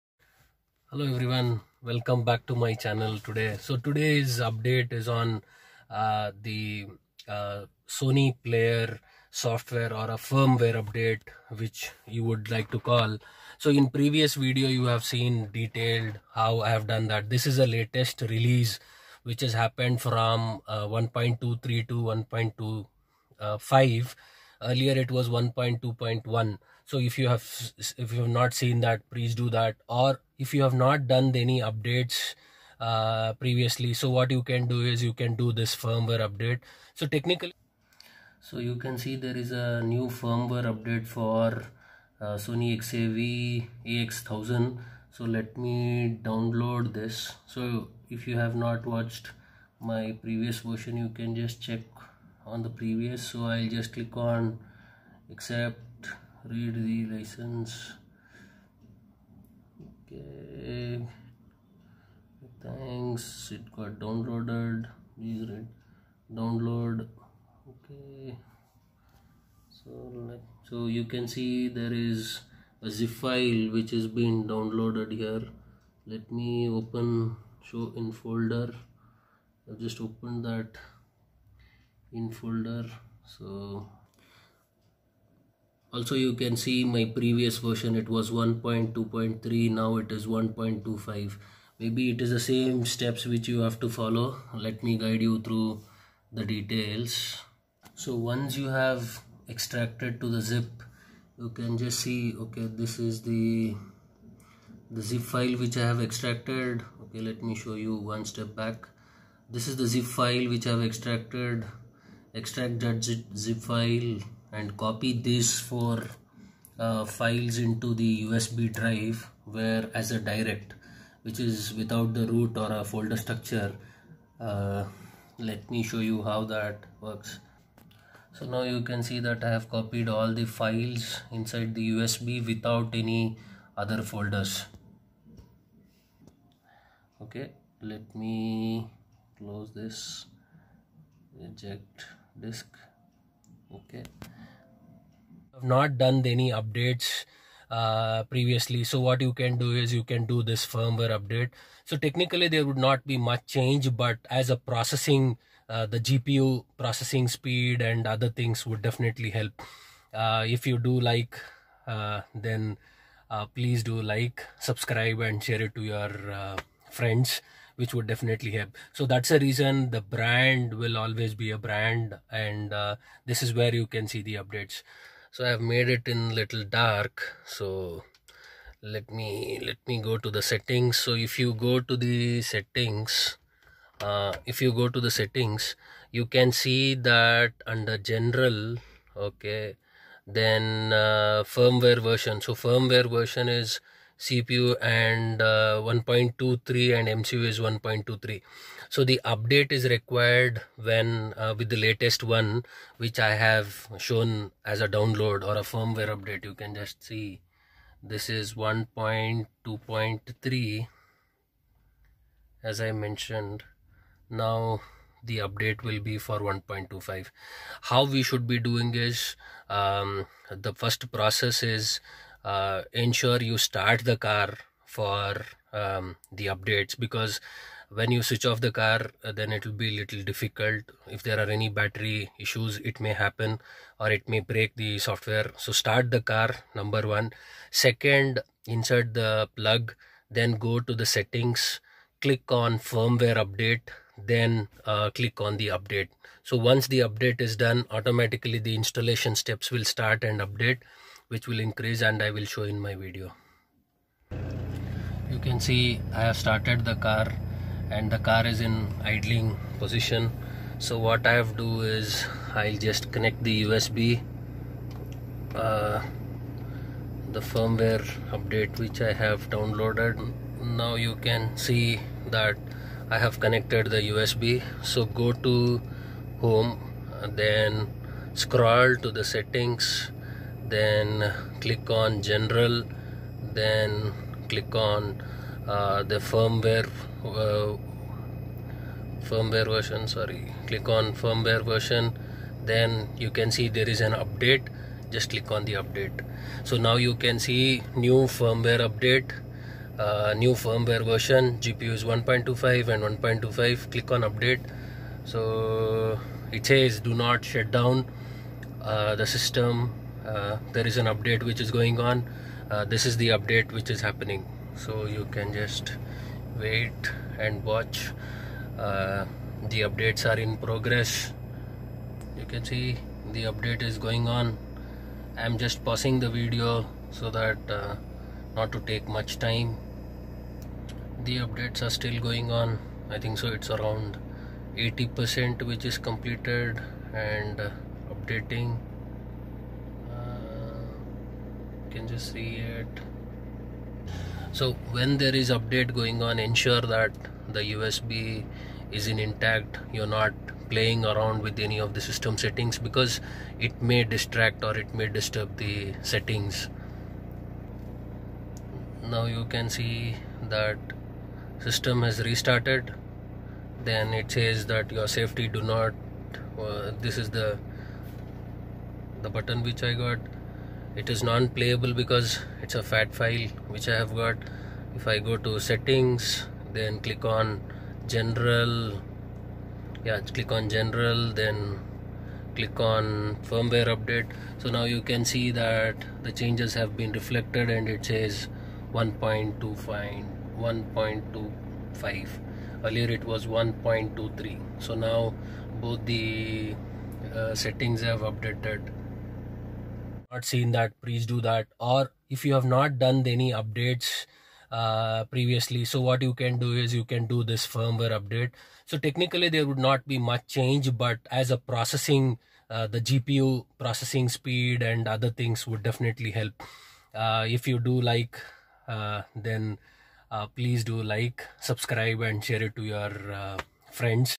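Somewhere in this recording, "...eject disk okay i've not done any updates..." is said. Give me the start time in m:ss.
2:21.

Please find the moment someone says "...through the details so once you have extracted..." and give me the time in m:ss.
1:35.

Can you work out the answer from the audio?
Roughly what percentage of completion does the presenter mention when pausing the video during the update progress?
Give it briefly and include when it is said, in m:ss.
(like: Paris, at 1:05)
80%, at 5:34.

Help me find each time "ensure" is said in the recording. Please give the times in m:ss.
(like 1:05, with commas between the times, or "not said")
3:42, 5:46.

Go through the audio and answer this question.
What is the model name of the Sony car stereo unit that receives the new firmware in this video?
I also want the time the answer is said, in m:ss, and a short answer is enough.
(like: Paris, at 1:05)
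XAV AX1000, at 0:42.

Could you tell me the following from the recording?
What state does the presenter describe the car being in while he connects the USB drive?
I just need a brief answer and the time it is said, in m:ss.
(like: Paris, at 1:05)
idling position, at 4:19.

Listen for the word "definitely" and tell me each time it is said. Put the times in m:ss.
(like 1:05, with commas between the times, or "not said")
2:38, 2:48, 6:55.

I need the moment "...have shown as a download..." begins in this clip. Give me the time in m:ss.
3:23.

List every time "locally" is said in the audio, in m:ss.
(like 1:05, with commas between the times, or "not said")
not said.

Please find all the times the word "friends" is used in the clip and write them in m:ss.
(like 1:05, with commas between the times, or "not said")
2:46, 7:03.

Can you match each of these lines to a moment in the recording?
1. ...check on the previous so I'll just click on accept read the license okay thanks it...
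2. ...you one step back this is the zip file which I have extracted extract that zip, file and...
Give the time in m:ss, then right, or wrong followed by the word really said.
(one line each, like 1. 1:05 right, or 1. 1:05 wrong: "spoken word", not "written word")
1. 0:51 right
2. 1:47 right.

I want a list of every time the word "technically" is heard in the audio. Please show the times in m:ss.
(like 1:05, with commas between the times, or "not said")
0:37, 2:31, 6:48.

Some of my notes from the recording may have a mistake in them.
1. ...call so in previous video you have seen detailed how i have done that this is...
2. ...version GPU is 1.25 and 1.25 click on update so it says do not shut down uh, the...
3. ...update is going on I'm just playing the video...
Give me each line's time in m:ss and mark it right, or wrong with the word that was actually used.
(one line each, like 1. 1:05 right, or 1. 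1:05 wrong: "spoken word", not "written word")
1. 0:12 right
2. 5:01 right
3. 5:23 wrong: "pausing", not "playing".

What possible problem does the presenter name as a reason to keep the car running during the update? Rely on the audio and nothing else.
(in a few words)
battery issues.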